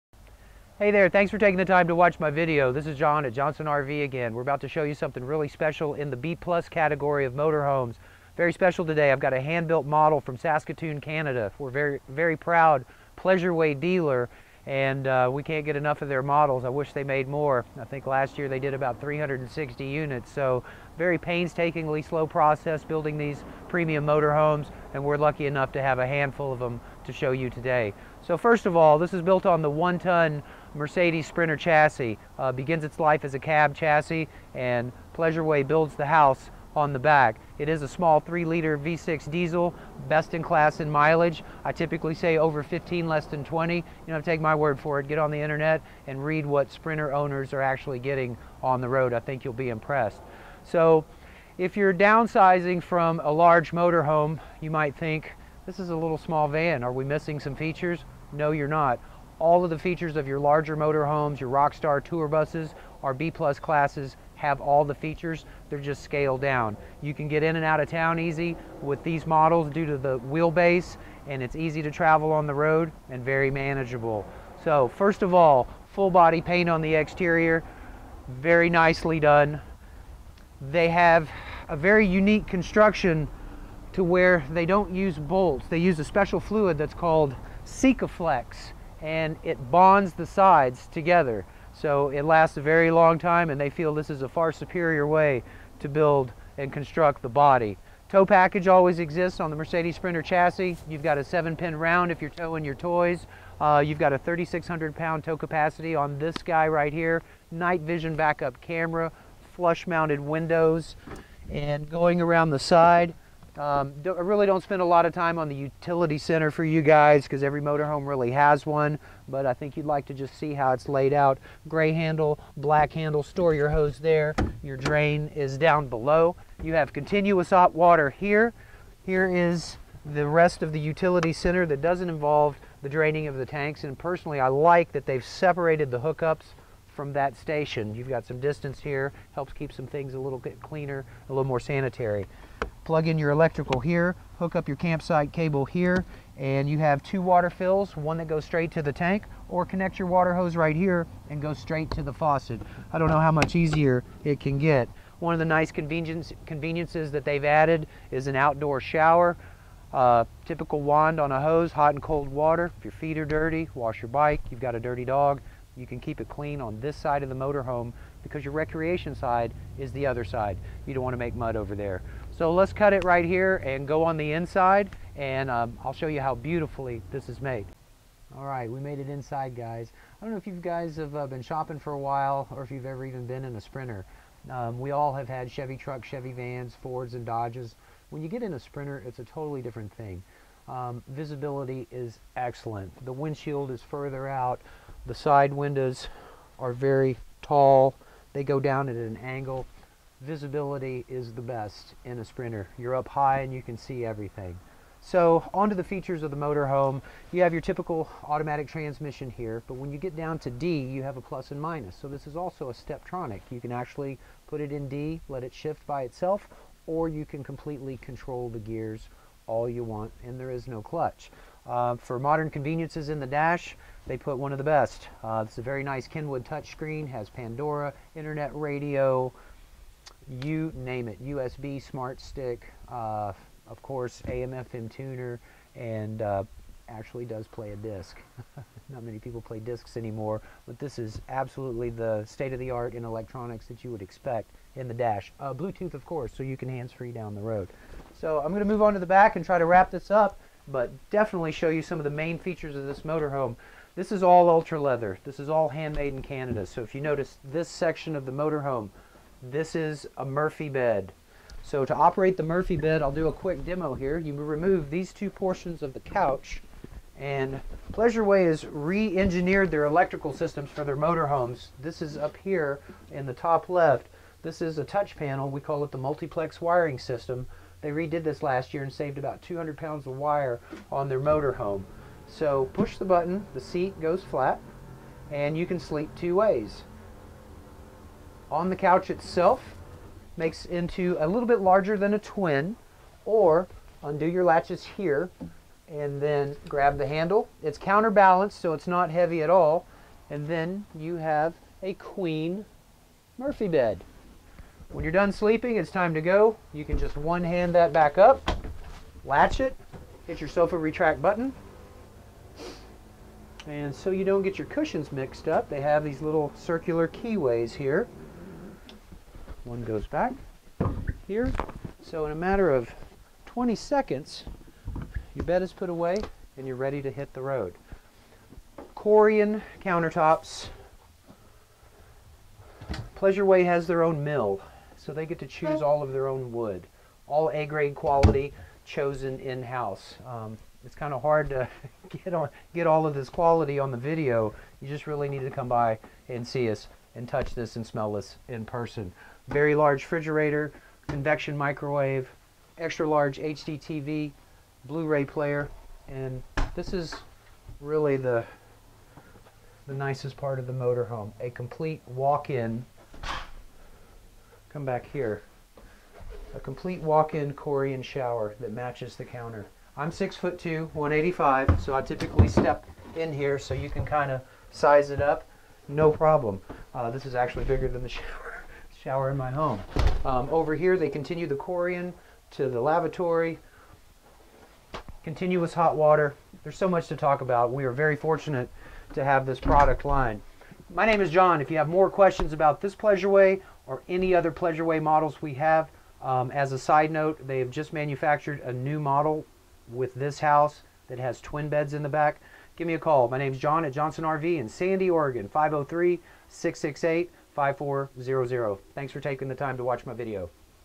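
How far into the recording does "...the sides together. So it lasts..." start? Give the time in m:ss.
1:30.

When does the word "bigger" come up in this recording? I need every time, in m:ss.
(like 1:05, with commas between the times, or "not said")
6:17.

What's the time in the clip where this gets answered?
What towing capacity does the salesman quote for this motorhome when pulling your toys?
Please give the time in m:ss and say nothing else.
1:44.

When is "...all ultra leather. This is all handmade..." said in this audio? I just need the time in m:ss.
4:14.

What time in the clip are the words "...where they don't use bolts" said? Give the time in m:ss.
1:24.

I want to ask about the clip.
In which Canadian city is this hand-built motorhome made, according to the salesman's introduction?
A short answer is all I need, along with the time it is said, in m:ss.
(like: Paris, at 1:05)
Saskatoon, at 0:10.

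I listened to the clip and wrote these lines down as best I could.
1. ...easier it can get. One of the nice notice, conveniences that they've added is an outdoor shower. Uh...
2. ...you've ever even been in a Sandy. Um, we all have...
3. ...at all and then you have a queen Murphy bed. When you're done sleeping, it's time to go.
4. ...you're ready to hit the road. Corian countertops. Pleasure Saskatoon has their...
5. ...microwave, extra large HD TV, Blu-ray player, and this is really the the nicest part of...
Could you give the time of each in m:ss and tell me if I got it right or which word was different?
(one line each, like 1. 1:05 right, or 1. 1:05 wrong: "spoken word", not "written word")
1. 2:33 wrong: "convenience", not "notice"
2. 3:02 wrong: "Sprinter", not "Sandy"
3. 4:59 right
4. 5:26 wrong: "Way", not "Saskatoon"
5. 5:51 right.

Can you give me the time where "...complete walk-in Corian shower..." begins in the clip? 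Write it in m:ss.
6:06.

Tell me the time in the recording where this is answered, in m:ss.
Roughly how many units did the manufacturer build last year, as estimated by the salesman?
0:19.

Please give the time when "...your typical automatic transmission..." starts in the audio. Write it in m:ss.
3:27.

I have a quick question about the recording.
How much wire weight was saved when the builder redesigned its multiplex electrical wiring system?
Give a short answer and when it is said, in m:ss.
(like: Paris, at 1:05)
200 pounds, at 4:39.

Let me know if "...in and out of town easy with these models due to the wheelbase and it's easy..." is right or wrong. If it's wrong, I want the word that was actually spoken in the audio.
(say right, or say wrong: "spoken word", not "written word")
right.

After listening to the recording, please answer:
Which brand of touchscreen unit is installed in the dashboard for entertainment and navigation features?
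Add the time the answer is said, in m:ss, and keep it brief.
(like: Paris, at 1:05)
Kenwood, at 3:46.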